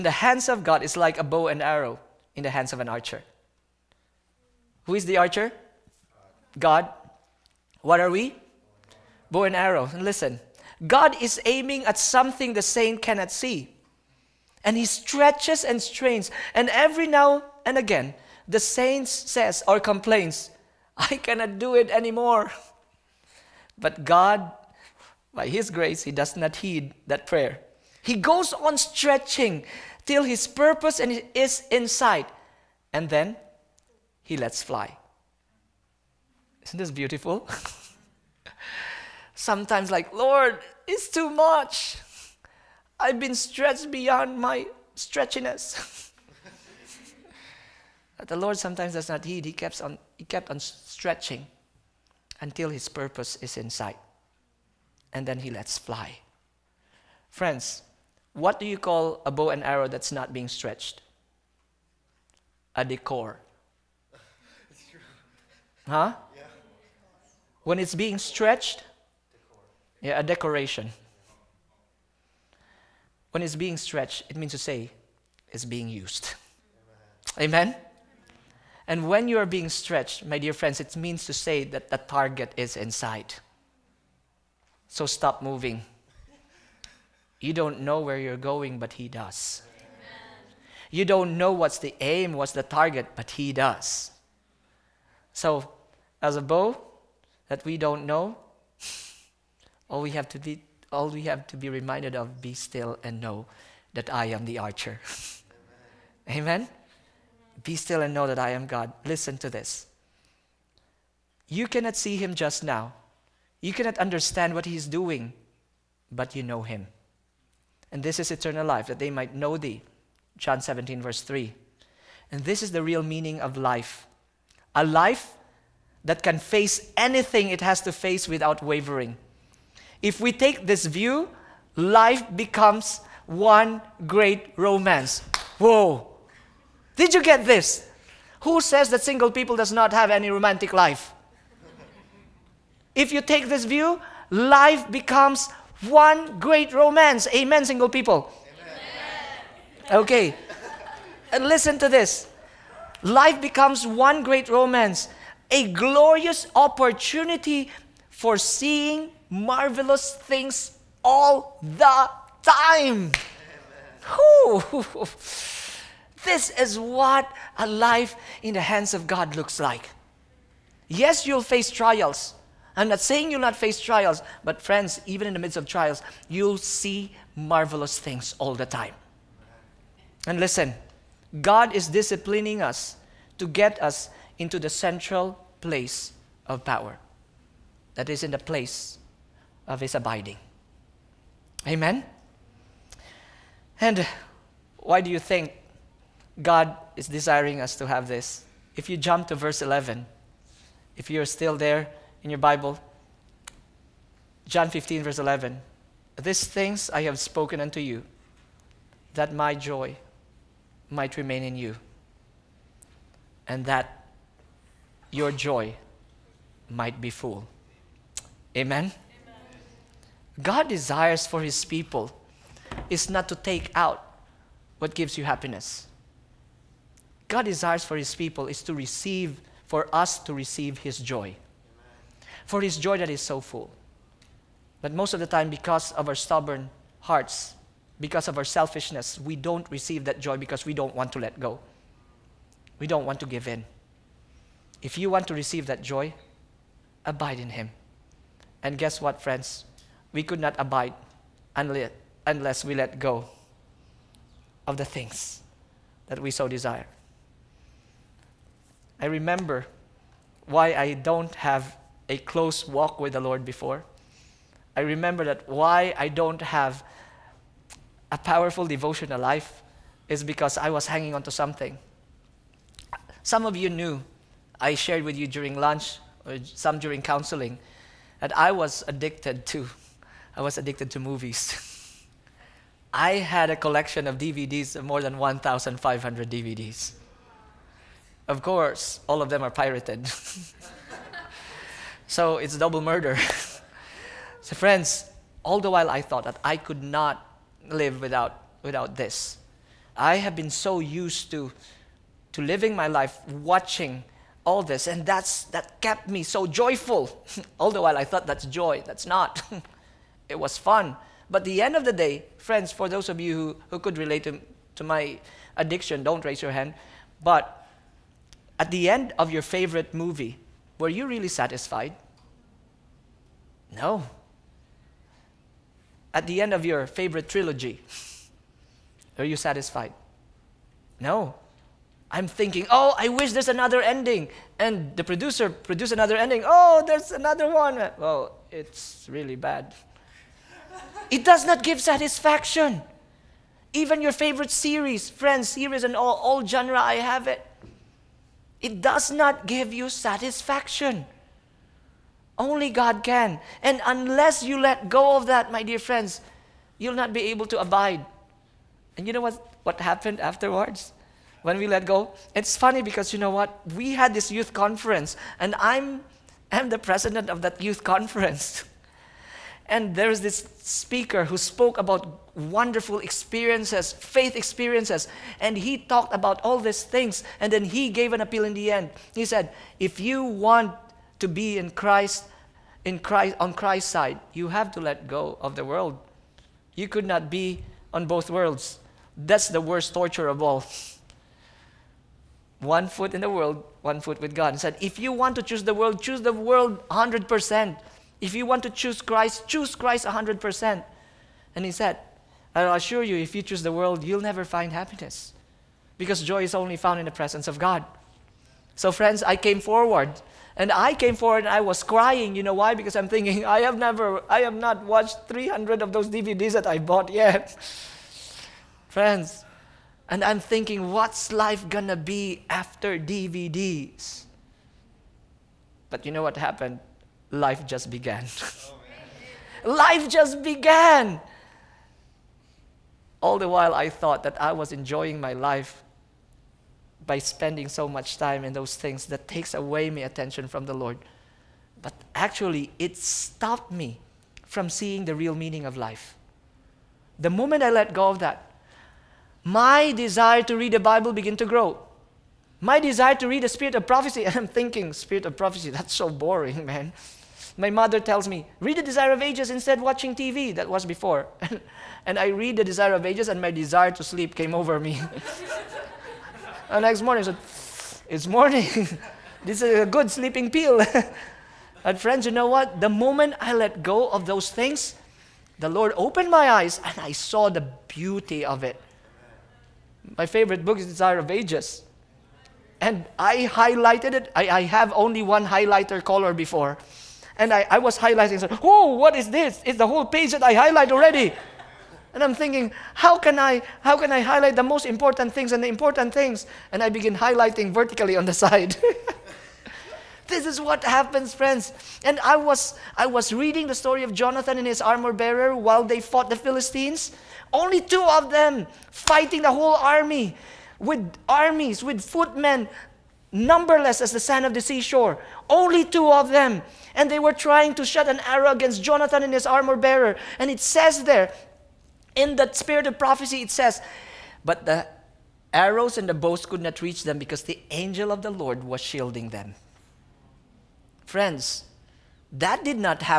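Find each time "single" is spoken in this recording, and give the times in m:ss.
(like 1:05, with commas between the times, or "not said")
2:19, 2:27.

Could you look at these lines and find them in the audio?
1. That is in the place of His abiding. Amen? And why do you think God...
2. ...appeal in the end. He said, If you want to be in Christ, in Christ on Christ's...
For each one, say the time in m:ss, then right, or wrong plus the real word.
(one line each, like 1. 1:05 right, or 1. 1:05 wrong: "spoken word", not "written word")
1. 3:07 right
2. 6:18 right.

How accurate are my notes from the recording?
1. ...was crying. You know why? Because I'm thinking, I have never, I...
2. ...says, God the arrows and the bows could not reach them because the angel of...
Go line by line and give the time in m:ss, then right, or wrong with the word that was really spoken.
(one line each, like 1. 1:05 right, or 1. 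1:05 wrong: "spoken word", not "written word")
1. 6:51 right
2. 8:43 wrong: "But", not "God".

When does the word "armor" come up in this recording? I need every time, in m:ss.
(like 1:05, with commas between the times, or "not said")
8:24, 8:39.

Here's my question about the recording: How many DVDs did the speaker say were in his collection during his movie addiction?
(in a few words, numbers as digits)
More than 1,500.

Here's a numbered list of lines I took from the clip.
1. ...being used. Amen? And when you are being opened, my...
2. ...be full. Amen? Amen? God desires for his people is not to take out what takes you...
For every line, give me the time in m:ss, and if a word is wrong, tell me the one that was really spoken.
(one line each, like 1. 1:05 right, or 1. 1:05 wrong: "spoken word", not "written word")
1. 1:15 wrong: "stretched", not "opened"
2. 3:36 wrong: "gives", not "takes".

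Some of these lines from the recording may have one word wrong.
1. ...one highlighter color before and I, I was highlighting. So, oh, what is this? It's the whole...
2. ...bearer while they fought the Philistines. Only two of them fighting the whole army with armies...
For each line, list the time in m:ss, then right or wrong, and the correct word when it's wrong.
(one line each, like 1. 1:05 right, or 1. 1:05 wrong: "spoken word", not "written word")
1. 8:05 right
2. 8:25 right.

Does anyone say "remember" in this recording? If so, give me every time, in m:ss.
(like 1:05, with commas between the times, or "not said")
4:19, 4:24.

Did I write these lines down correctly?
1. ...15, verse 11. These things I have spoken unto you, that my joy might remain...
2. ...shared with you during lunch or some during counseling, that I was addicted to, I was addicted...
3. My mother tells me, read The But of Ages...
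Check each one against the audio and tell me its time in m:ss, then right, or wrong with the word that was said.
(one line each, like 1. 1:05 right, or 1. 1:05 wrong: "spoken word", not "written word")
1. 3:24 right
2. 4:34 right
3. 7:37 wrong: "Desire", not "But".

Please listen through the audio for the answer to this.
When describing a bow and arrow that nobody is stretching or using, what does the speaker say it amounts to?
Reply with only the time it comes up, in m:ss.
1:02.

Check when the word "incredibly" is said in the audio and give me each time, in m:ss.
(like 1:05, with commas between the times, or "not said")
not said.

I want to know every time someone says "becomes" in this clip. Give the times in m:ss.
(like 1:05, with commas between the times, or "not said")
2:12, 2:24, 2:33.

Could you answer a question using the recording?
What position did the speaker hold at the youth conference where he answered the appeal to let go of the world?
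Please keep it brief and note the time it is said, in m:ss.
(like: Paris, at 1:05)
President, at 6:06.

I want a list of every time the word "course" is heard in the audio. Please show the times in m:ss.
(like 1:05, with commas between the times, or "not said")
4:48.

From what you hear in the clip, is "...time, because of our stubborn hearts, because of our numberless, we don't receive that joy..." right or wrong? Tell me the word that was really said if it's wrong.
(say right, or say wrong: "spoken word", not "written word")
wrong: "selfishness", not "numberless".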